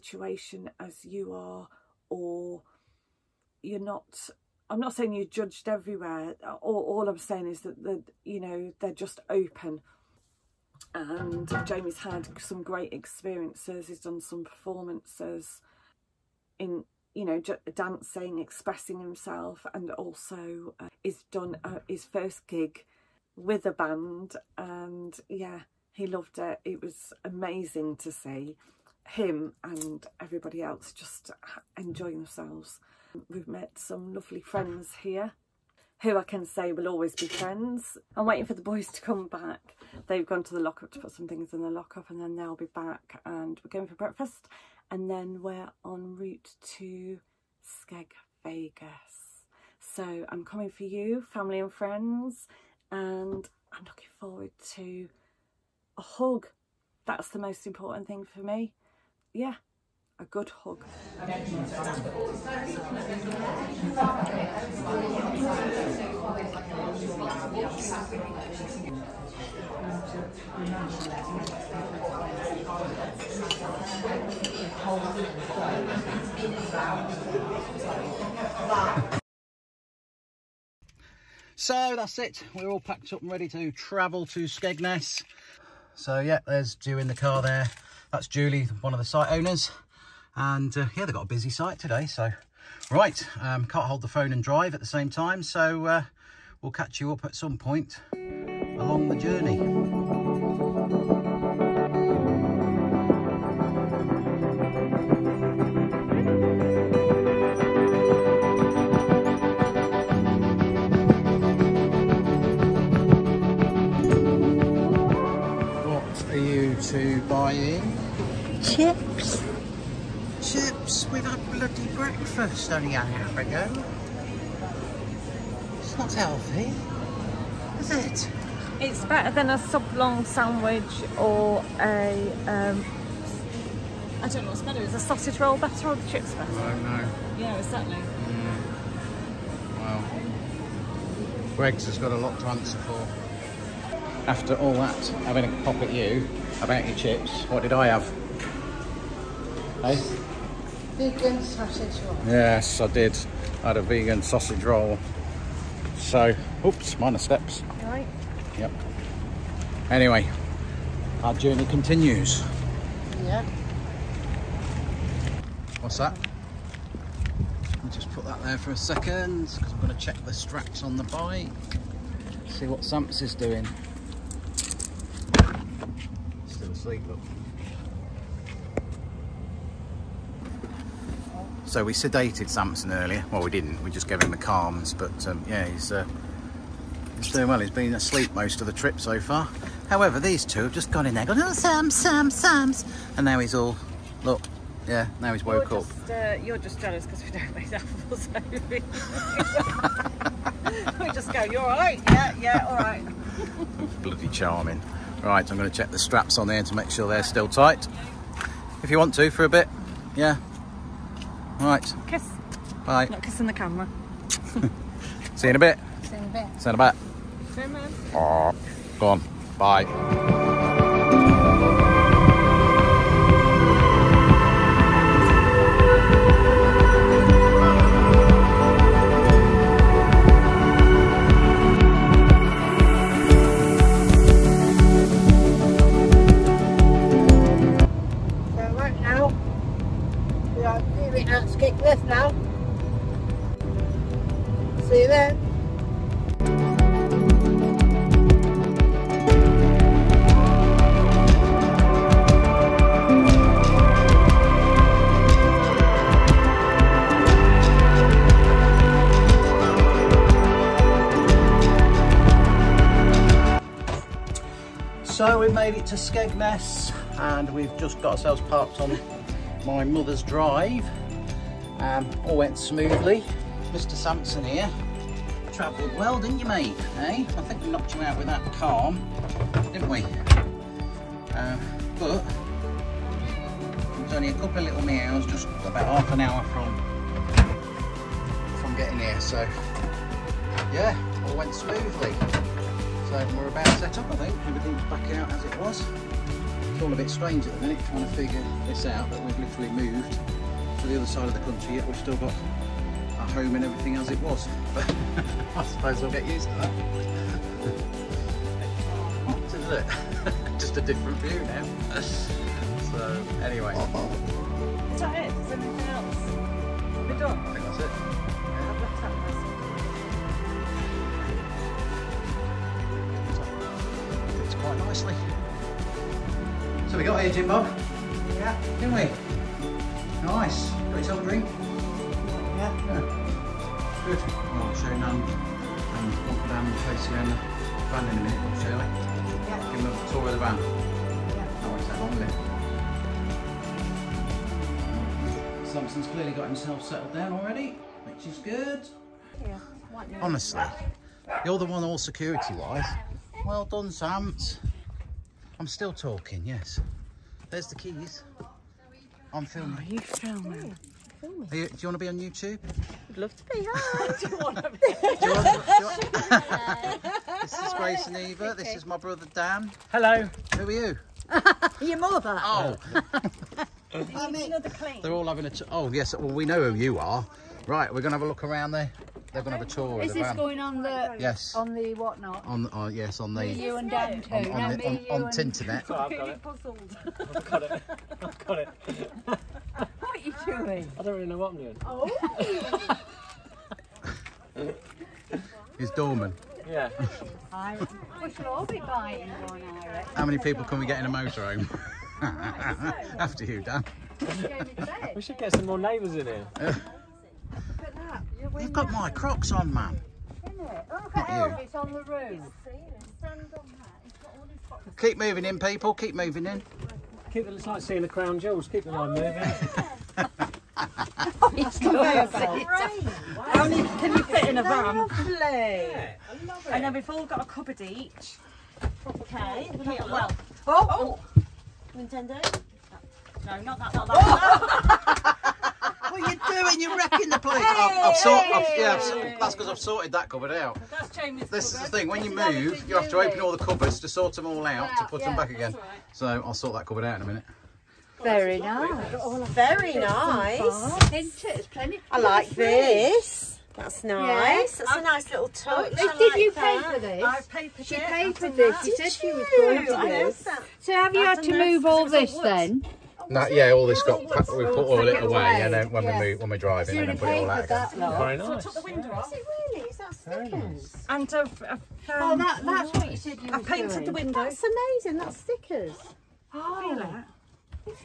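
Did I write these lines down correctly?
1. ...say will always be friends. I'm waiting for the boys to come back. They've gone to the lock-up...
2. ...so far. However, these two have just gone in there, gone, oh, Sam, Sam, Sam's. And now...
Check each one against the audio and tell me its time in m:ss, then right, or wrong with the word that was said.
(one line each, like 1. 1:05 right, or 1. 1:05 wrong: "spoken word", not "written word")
1. 0:36 right
2. 3:08 right.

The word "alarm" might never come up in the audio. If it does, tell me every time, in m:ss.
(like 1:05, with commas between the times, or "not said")
not said.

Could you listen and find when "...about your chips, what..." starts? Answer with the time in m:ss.
2:26.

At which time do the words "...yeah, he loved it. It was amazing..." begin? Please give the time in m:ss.
0:25.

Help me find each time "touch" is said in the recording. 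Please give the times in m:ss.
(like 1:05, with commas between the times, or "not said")
7:35.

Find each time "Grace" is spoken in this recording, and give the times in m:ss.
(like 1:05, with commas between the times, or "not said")
6:07.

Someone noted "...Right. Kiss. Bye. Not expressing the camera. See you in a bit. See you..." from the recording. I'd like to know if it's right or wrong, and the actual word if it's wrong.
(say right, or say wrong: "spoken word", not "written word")
wrong: "kissing", not "expressing".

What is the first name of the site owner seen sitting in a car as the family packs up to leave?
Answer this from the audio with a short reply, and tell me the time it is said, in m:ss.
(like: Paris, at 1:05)
Julie, at 1:28.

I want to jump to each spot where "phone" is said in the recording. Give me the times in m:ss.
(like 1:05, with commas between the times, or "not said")
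1:34.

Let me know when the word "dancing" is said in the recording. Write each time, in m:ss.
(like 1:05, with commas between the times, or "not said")
0:17.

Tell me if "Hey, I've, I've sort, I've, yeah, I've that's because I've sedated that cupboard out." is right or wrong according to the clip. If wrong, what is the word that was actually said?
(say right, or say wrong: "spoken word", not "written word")
wrong: "sorted", not "sedated".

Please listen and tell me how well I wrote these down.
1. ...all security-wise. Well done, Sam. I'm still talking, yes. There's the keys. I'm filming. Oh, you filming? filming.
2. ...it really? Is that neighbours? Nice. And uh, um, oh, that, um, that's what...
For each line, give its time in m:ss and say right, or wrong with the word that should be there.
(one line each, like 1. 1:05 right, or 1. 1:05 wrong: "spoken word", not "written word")
1. 5:51 right
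2. 7:49 wrong: "stickers", not "neighbours".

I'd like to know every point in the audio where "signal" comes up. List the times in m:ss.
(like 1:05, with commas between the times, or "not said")
not said.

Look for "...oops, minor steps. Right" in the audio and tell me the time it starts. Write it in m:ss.
2:36.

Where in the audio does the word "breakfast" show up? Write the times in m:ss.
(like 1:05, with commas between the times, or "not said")
0:43, 2:01.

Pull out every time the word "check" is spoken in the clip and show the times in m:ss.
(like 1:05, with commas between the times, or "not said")
2:49, 3:25.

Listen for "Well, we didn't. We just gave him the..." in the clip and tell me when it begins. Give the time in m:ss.
3:03.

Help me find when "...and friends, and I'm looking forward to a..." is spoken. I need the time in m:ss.
0:51.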